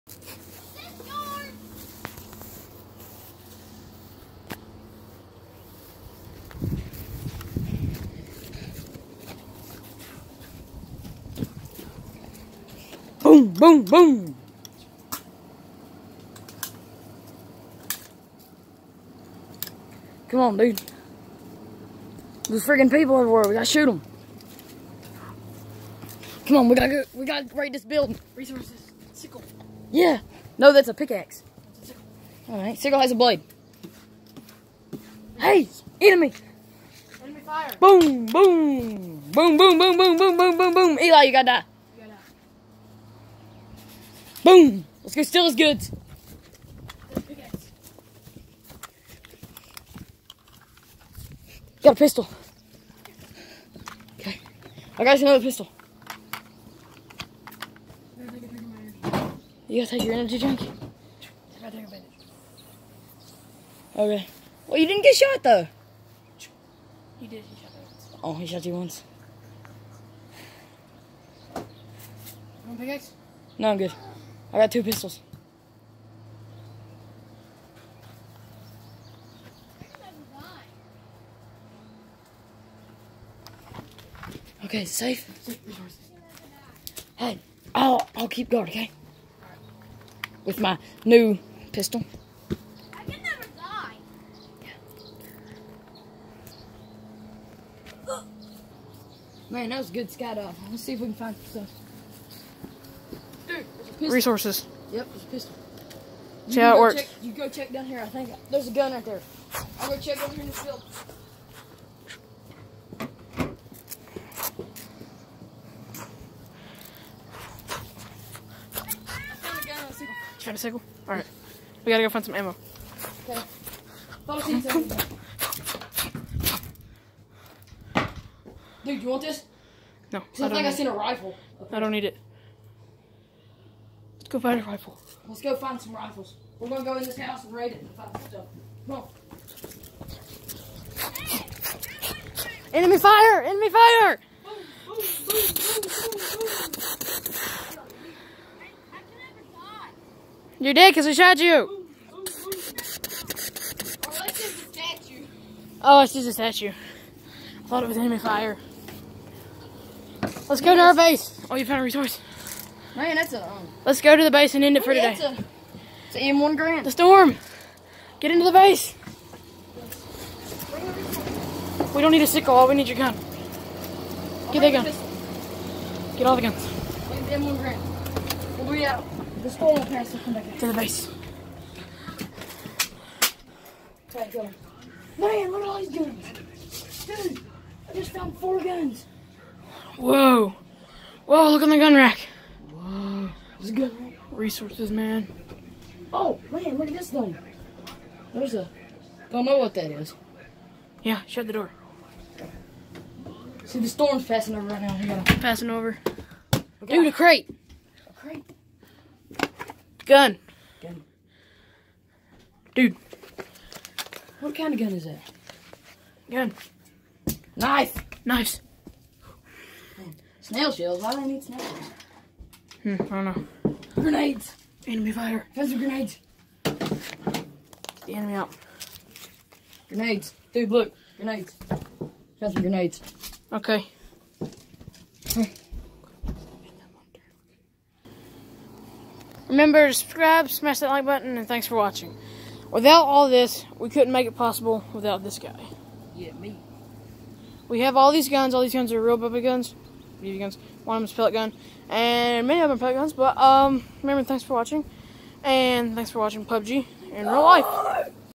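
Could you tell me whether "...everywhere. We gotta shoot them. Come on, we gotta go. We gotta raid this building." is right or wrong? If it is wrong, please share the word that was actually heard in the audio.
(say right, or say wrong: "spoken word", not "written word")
right.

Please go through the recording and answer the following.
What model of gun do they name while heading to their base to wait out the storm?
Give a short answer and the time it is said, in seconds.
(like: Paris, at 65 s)
M1 Grant, at 177 s.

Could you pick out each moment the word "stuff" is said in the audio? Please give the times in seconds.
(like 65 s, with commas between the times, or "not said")
101 s, 138 s.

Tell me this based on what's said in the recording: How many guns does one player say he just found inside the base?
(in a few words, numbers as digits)
4.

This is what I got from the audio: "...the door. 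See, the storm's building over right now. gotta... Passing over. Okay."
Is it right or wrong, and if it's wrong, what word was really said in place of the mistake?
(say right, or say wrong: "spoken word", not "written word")
wrong: "passing", not "building".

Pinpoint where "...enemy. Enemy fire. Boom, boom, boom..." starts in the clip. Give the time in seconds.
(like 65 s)
35 s.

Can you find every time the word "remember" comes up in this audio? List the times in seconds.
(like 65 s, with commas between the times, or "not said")
239 s, 254 s.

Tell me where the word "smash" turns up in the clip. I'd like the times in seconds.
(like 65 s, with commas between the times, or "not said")
240 s.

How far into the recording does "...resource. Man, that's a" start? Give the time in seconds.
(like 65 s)
161 s.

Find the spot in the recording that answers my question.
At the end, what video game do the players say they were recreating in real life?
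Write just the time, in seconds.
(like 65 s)
256 s.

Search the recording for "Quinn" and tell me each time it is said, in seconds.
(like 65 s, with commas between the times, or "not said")
not said.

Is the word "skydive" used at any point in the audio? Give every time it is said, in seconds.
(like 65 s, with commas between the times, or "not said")
100 s.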